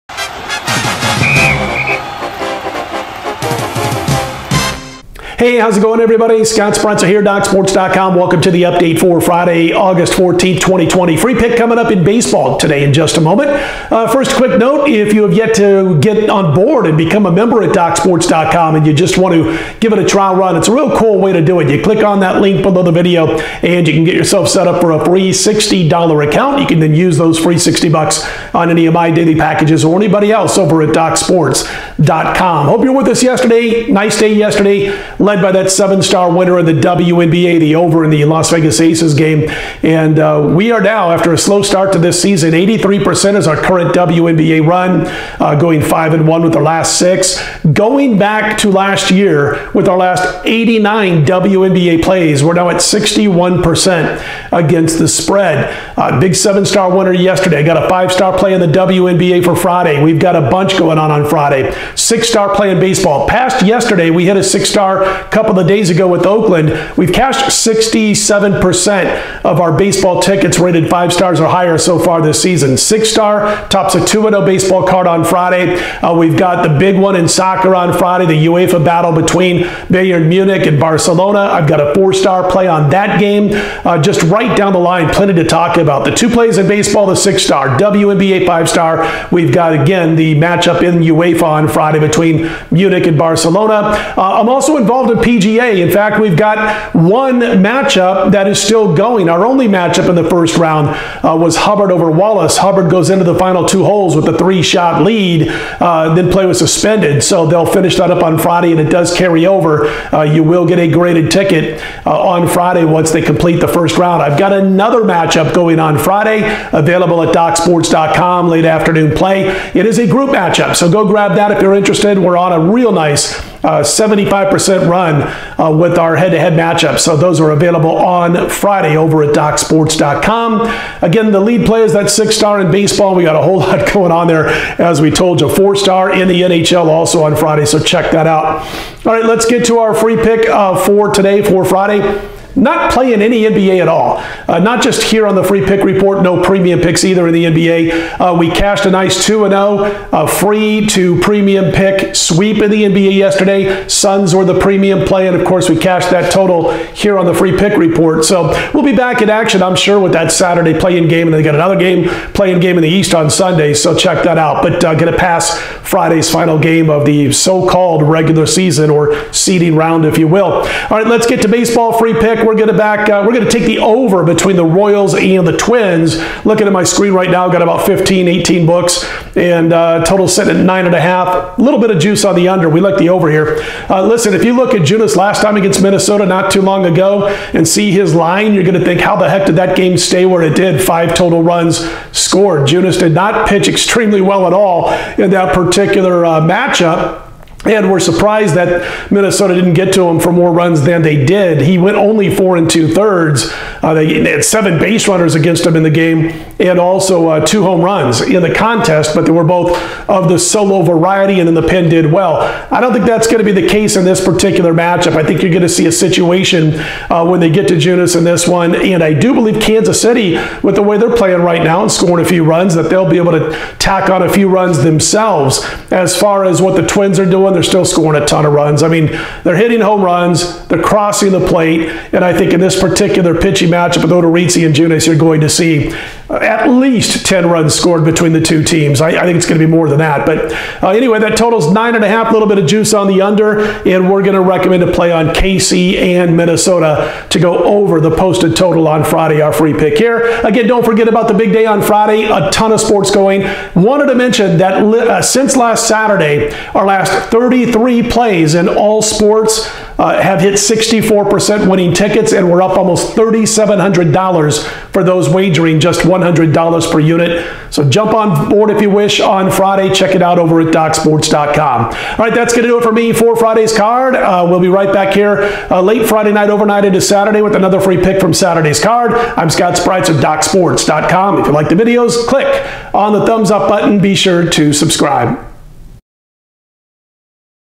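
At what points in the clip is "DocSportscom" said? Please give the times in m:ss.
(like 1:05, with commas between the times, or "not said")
0:07, 0:17, 0:30, 1:57, 2:09, 4:30, 4:40.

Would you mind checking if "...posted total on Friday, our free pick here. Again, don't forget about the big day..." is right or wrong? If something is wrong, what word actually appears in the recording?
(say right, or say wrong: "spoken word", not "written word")
right.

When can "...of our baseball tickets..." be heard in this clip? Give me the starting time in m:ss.
1:09.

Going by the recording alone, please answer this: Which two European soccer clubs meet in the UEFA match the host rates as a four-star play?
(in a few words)
Bayern Munich and Barcelona.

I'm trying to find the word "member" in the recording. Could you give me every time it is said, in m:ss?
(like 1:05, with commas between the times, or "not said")
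0:17.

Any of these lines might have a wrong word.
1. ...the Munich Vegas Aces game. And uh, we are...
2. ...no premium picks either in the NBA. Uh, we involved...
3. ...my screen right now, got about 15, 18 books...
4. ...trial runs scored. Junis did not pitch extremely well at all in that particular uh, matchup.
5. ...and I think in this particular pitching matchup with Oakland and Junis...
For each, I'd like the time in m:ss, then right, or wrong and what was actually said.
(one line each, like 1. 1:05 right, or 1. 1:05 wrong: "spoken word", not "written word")
1. 0:38 wrong: "Las", not "Munich"
2. 2:26 wrong: "cashed", not "involved"
3. 2:56 right
4. 3:11 wrong: "total", not "trial"
5. 3:52 wrong: "Odorizzi", not "Oakland".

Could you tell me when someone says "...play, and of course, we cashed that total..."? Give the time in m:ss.
2:35.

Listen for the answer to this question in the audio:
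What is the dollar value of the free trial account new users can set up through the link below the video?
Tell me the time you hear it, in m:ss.
0:25.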